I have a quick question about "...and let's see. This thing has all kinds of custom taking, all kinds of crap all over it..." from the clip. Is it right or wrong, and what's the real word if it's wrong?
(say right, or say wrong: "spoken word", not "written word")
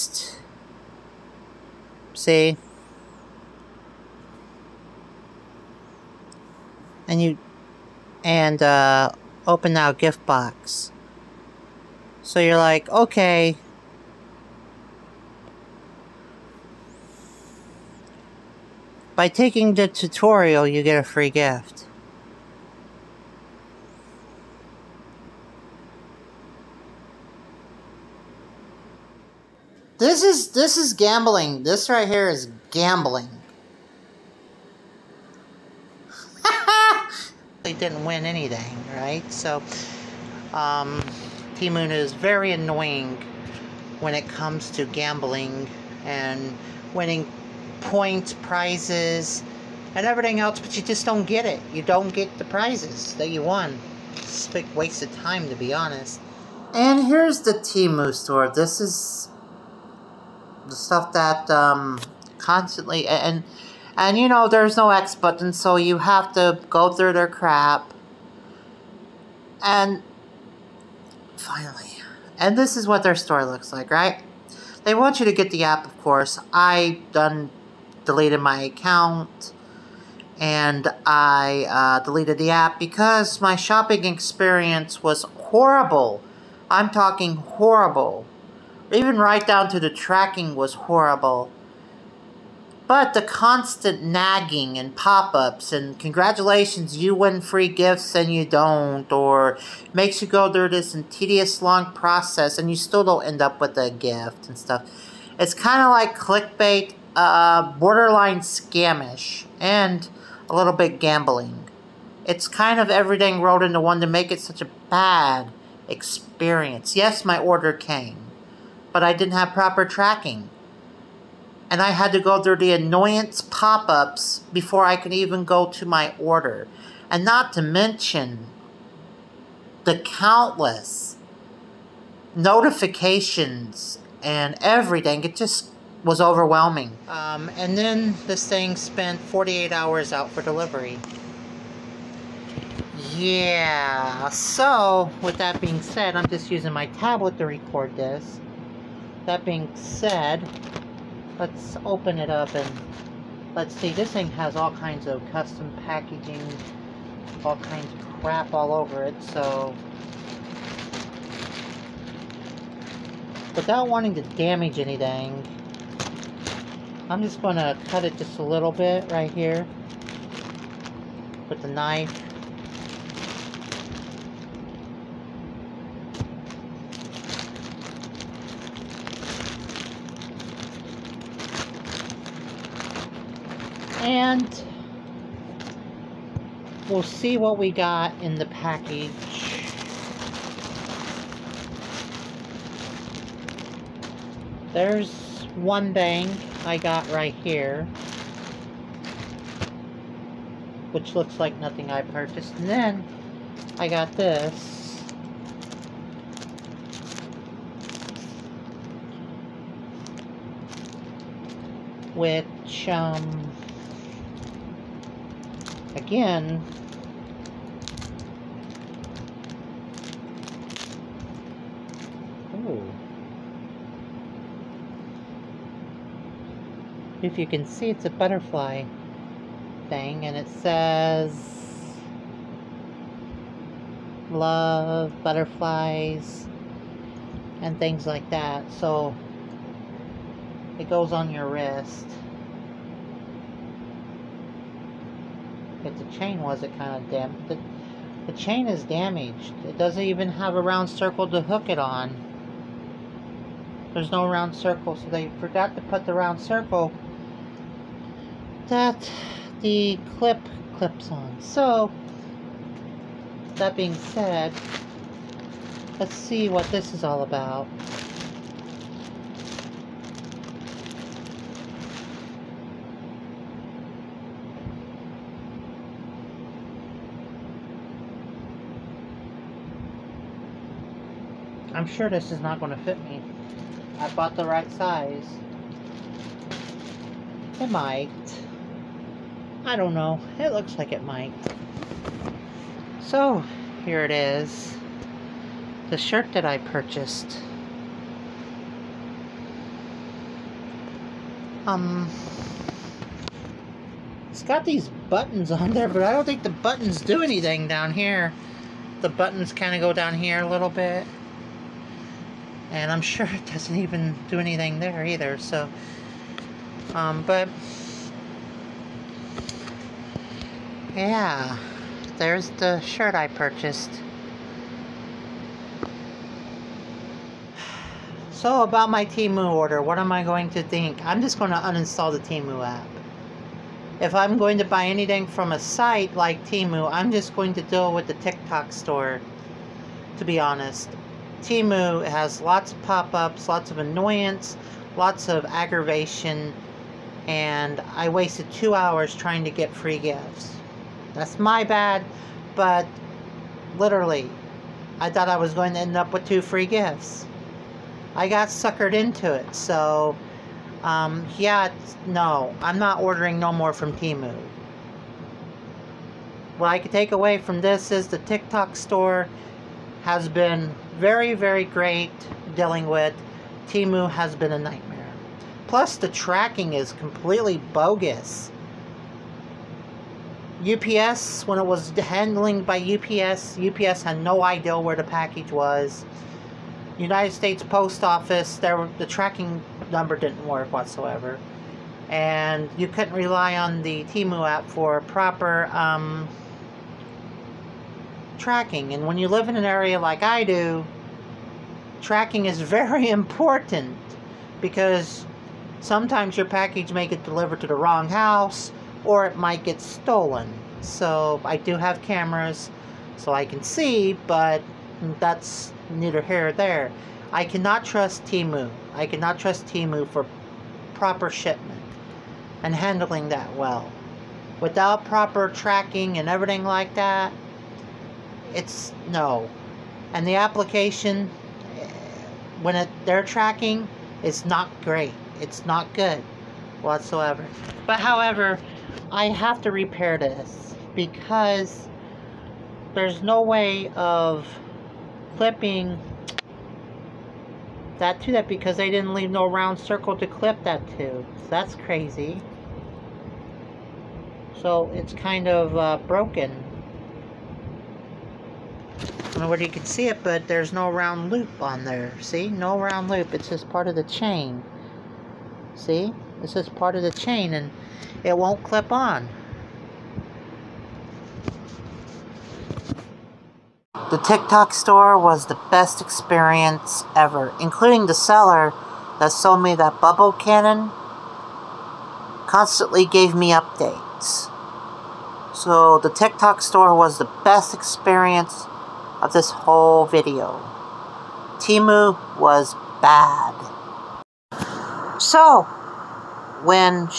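wrong: "packaging", not "taking".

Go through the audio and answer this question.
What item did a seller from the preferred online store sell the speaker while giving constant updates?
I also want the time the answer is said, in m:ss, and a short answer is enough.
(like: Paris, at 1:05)
Bubble cannon, at 7:59.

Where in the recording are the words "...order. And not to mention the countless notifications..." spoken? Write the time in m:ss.
2:06.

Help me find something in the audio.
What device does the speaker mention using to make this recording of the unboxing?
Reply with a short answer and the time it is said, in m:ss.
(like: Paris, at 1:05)
Tablet, at 2:26.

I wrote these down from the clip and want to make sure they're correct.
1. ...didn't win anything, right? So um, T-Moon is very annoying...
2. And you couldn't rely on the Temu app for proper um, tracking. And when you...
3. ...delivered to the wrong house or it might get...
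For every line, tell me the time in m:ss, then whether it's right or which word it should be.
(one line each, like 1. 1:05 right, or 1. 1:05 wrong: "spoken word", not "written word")
1. 0:37 right
2. 6:32 right
3. 6:47 right.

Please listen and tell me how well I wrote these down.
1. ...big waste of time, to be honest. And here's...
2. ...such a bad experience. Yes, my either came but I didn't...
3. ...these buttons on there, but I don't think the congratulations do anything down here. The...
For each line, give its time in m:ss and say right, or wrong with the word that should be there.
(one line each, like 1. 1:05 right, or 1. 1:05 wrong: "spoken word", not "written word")
1. 0:54 right
2. 1:54 wrong: "order", not "either"
3. 5:04 wrong: "buttons", not "congratulations".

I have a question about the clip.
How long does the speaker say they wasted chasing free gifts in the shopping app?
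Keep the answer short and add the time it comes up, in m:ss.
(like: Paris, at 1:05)
Two hours, at 5:48.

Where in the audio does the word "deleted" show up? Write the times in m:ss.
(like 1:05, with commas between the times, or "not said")
1:18, 1:22.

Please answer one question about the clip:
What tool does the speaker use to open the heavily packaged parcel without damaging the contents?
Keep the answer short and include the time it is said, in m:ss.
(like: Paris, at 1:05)
Knife, at 2:51.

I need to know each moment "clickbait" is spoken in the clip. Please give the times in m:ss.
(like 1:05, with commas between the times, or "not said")
1:46.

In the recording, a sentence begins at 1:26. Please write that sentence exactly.
I'm talking horrible even right down to the tracking was horrible.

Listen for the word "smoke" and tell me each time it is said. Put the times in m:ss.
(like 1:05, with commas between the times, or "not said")
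not said.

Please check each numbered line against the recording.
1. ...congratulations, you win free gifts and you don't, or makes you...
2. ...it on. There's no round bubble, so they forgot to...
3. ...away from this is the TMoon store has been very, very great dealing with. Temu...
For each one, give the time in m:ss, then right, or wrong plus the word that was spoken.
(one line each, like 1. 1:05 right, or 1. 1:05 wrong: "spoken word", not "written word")
1. 1:35 right
2. 4:11 wrong: "circle", not "bubble"
3. 6:07 wrong: "TikTok", not "TMoon".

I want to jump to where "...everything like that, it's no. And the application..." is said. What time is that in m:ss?
7:06.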